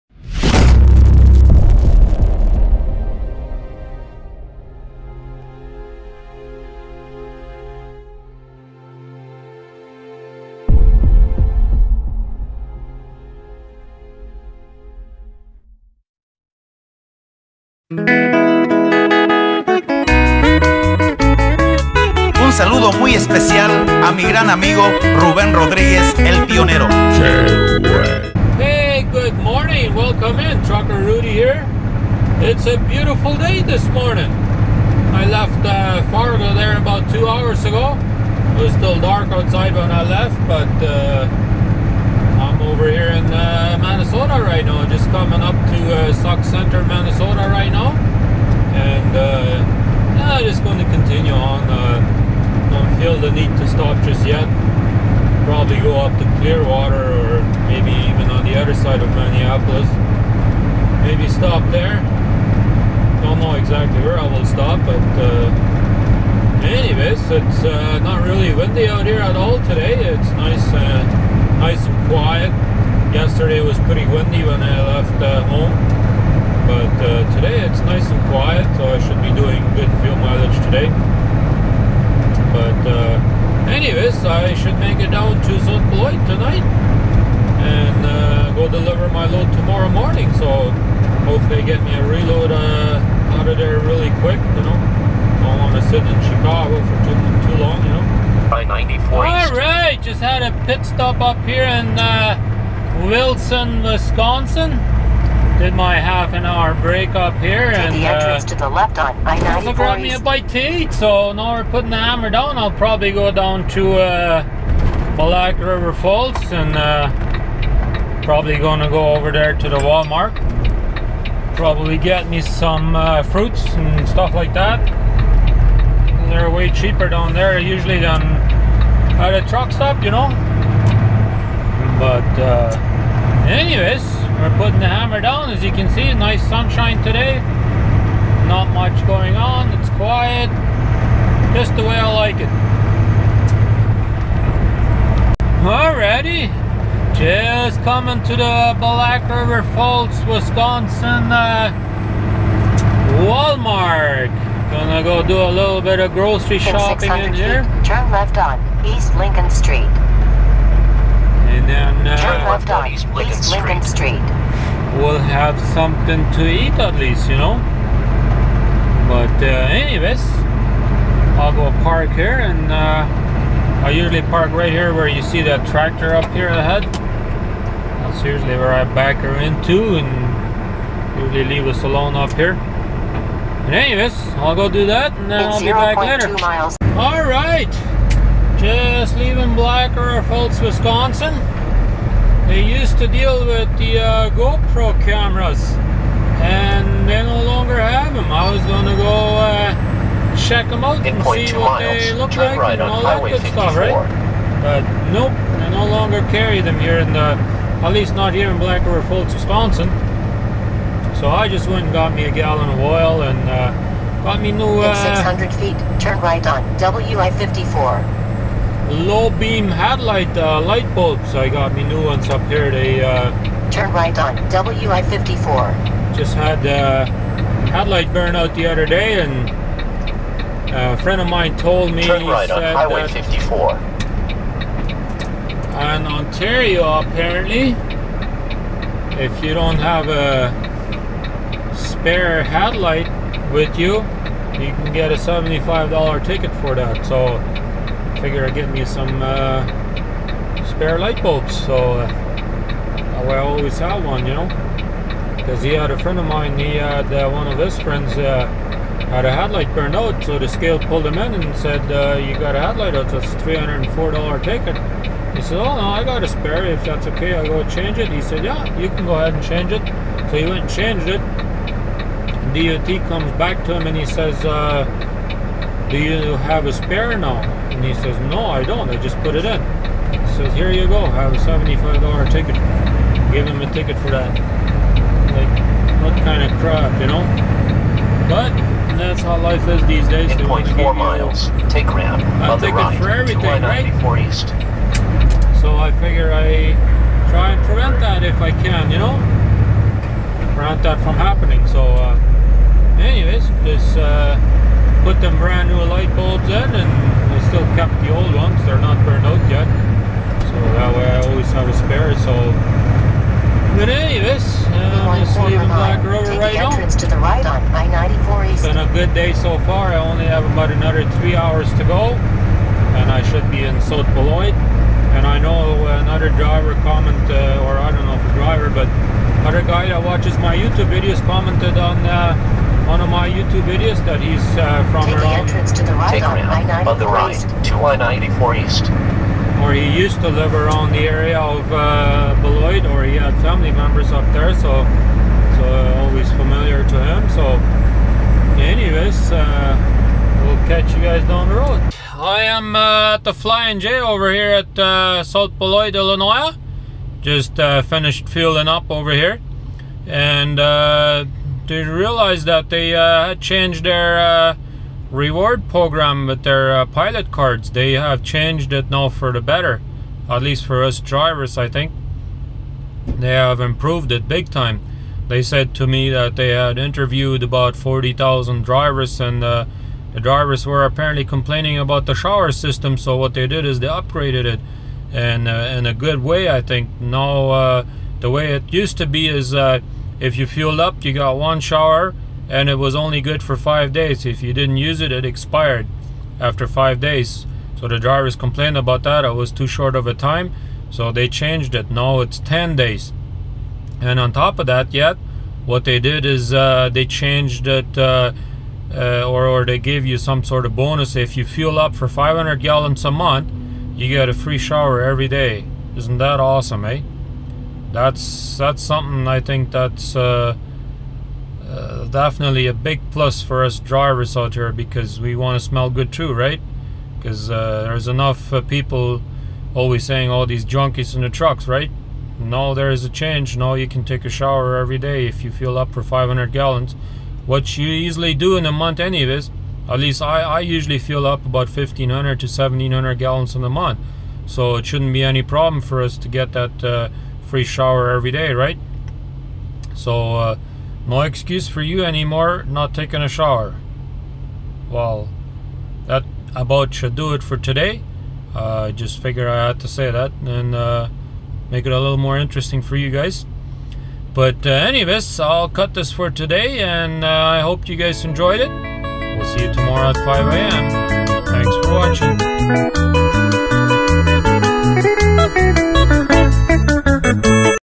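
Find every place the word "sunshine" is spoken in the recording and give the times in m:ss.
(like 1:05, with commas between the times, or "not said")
2:16.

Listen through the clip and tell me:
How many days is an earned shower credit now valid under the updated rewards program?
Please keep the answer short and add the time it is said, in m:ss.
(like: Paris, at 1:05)
10 days, at 6:42.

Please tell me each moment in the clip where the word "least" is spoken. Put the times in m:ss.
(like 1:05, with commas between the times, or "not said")
2:46, 3:27, 6:10, 7:19.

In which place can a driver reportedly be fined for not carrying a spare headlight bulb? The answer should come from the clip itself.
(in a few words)
Ontario.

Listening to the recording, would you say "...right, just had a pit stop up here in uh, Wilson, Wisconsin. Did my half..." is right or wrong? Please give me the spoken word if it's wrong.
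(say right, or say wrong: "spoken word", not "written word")
right.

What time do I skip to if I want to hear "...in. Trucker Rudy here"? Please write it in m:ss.
0:30.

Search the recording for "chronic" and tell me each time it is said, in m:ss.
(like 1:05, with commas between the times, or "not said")
not said.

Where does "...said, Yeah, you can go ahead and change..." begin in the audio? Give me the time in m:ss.
4:28.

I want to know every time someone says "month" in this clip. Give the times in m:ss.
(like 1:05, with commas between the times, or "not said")
6:53, 7:18, 7:23.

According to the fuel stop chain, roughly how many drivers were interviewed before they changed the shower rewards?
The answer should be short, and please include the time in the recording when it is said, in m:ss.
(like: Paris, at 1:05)
40,000, at 6:17.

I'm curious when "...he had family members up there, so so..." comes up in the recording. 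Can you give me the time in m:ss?
5:43.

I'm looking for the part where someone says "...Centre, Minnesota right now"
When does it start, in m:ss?
0:46.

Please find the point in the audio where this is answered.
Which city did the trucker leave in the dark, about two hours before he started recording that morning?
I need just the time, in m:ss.
0:36.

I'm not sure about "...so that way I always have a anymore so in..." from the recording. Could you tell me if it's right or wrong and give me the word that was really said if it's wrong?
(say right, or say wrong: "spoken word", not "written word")
wrong: "spare", not "anymore".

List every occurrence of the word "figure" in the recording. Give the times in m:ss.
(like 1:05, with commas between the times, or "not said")
4:08, 4:55, 7:39.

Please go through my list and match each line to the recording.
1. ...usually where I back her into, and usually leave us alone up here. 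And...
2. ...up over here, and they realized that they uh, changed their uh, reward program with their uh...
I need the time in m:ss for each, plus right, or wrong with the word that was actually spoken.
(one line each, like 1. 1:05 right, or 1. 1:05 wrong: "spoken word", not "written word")
1. 2:58 right
2. 5:58 right.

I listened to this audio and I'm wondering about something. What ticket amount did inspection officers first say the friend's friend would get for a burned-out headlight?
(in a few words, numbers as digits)
$304.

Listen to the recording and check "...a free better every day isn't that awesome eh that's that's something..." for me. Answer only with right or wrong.
wrong.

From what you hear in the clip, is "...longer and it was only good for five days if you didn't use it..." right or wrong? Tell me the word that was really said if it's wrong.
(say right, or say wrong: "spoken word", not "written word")
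wrong: "shower", not "longer".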